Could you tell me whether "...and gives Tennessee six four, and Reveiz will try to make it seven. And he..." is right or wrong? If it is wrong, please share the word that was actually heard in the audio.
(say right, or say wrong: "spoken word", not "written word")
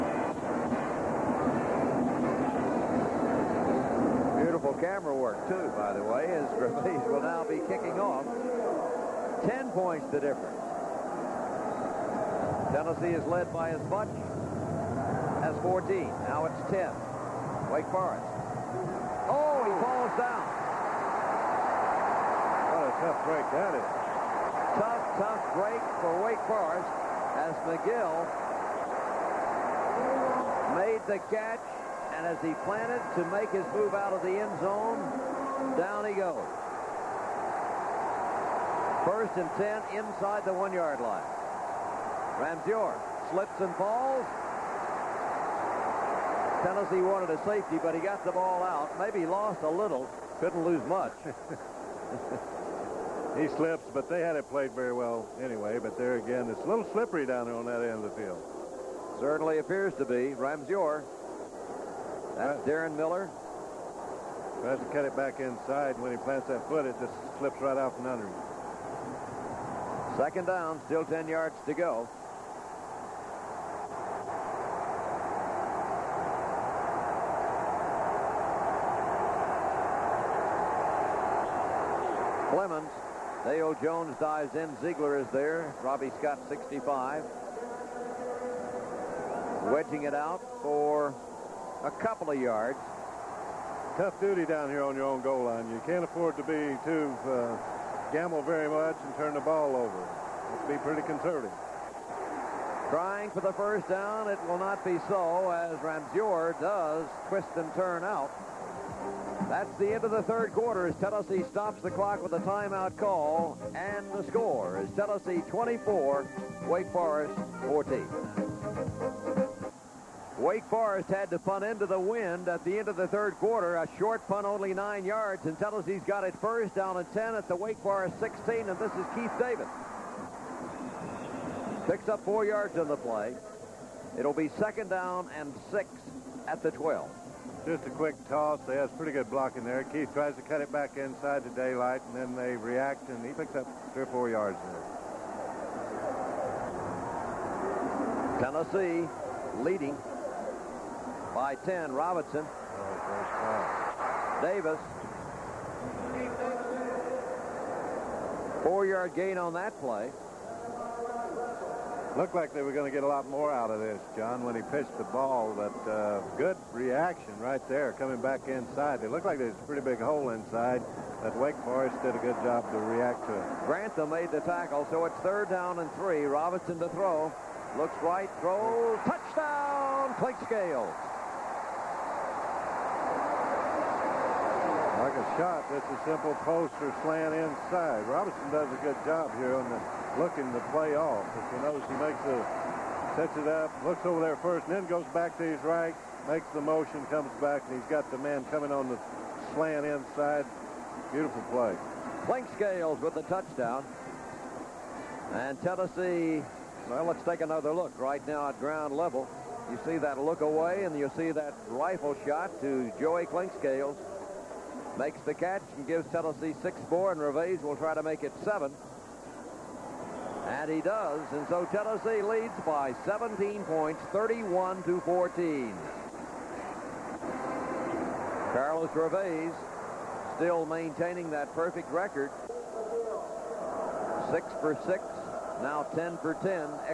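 right.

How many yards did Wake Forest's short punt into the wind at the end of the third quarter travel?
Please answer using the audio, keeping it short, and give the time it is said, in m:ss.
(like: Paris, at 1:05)
9, at 2:04.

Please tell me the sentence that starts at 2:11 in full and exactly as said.
Picks up four yards in the play.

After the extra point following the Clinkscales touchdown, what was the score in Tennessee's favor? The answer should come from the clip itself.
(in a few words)
31 to 14.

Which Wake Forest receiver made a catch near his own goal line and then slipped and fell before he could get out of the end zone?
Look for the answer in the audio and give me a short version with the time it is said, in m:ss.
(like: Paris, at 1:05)
McGill, at 0:27.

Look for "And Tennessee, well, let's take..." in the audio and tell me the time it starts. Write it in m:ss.
3:25.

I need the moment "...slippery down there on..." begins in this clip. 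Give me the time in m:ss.
0:56.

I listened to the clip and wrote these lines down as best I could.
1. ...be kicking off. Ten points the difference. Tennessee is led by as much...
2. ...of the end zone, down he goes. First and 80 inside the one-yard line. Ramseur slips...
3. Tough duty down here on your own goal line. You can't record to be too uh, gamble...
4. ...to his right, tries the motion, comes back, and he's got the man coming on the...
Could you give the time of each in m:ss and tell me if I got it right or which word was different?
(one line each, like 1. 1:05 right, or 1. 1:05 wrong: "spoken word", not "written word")
1. 0:07 right
2. 0:34 wrong: "10", not "80"
3. 1:33 wrong: "afford", not "record"
4. 3:15 wrong: "makes", not "tries".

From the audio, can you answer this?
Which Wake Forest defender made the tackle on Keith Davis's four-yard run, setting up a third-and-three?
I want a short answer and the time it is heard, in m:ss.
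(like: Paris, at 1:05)
Grantham, at 2:53.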